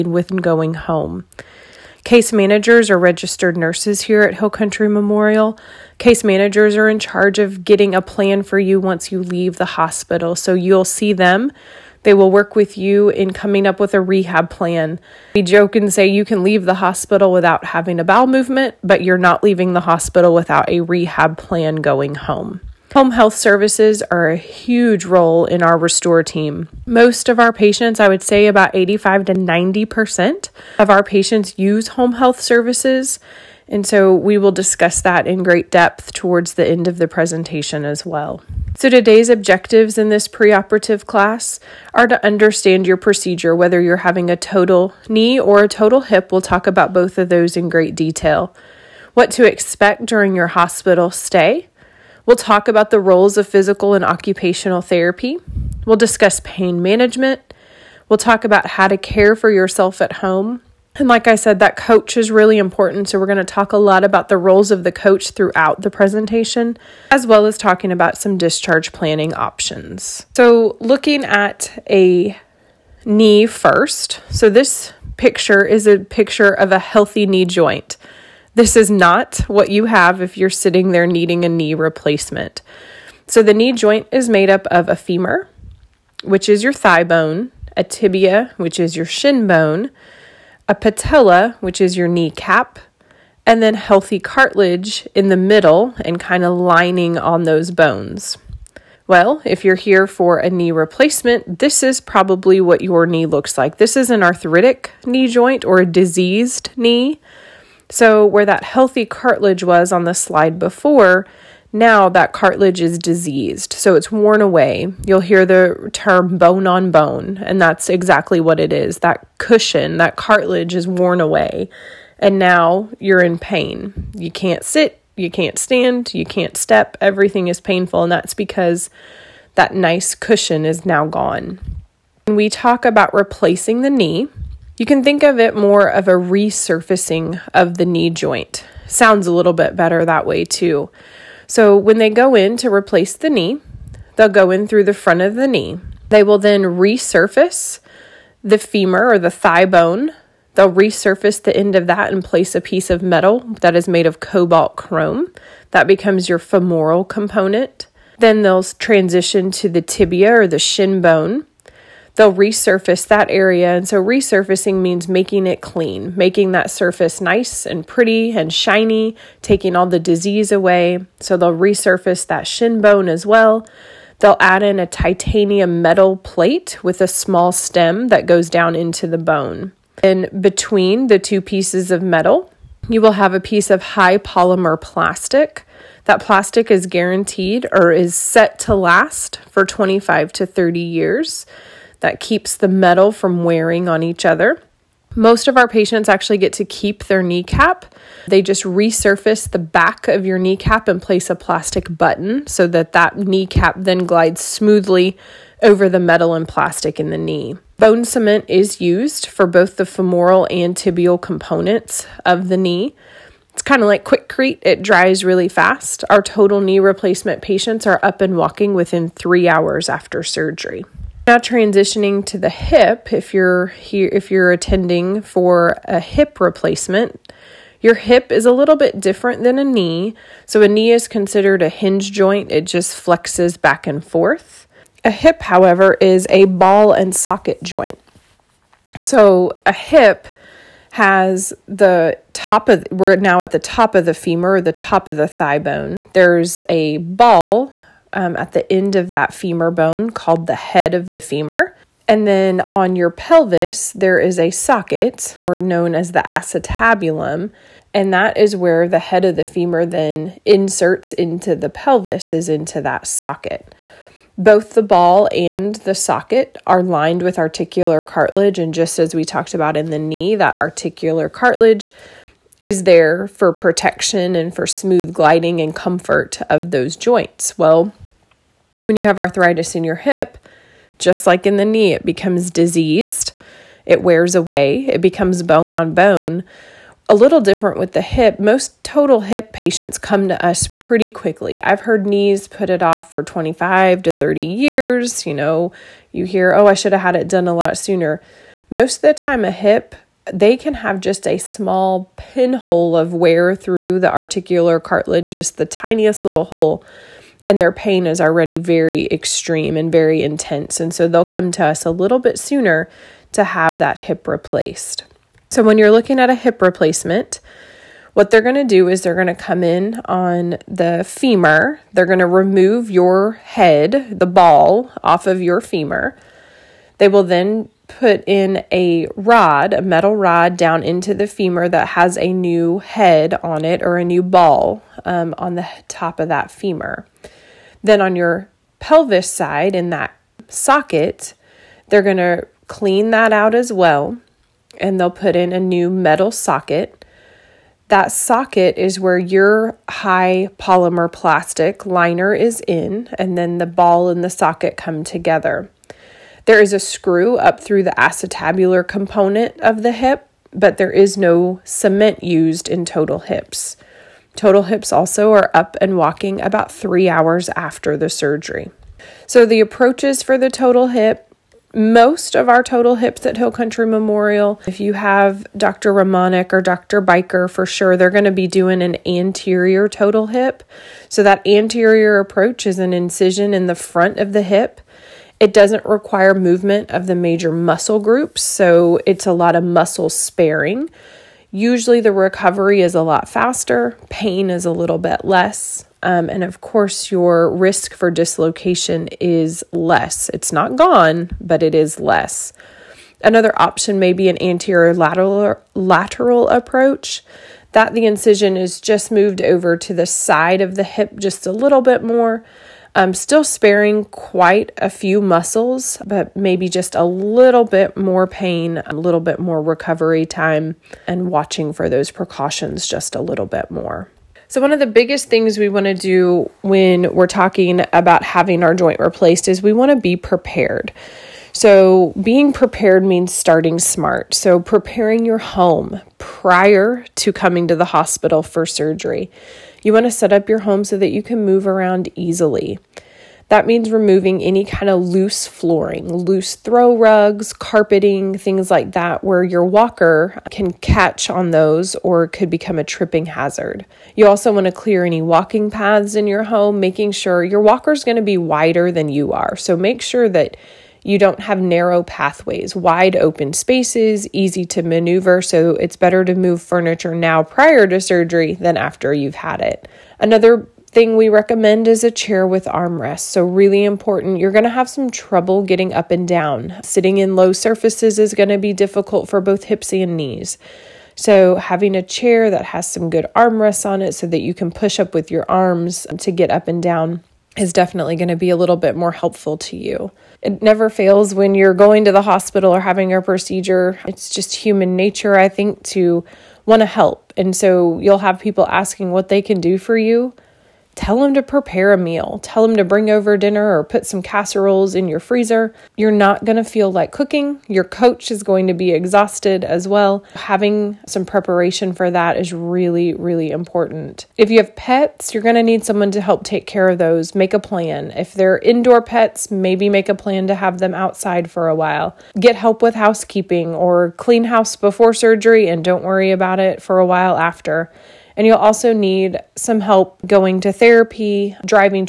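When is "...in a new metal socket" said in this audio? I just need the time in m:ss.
5:45.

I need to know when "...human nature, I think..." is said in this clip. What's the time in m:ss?
8:14.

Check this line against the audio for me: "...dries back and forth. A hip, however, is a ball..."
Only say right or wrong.
wrong.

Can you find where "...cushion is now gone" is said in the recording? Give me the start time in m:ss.
2:10.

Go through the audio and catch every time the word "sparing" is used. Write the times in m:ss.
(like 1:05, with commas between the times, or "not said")
6:30, 6:53.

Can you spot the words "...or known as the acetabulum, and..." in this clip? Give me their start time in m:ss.
4:15.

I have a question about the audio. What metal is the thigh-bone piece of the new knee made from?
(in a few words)
Cobalt chrome.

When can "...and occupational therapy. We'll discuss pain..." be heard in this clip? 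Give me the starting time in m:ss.
0:53.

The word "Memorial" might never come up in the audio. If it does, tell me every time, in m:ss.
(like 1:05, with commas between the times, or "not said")
0:04, 6:13.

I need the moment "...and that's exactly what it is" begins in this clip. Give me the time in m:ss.
1:57.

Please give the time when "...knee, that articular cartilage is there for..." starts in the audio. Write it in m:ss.
4:29.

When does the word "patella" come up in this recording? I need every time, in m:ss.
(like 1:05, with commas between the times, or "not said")
1:30.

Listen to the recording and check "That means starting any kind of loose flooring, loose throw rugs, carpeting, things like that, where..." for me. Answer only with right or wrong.
wrong.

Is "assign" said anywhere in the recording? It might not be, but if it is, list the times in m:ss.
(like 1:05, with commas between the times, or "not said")
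not said.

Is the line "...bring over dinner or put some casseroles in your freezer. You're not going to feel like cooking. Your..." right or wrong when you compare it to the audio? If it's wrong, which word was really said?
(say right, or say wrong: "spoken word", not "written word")
right.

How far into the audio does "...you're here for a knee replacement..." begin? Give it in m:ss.
1:39.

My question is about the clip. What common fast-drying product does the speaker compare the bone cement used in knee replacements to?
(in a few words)
Quikrete.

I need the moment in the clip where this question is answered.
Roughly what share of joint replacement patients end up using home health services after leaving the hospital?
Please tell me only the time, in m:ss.
0:28.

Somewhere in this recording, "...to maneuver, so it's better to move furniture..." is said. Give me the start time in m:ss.
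7:44.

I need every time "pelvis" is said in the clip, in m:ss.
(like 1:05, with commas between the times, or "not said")
4:13, 4:21, 5:38.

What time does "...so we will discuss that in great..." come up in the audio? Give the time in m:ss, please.
0:33.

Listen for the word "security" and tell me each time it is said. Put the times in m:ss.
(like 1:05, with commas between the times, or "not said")
not said.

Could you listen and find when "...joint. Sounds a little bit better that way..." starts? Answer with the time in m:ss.
2:18.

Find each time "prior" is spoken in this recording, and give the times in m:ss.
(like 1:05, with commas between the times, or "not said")
7:16, 7:47.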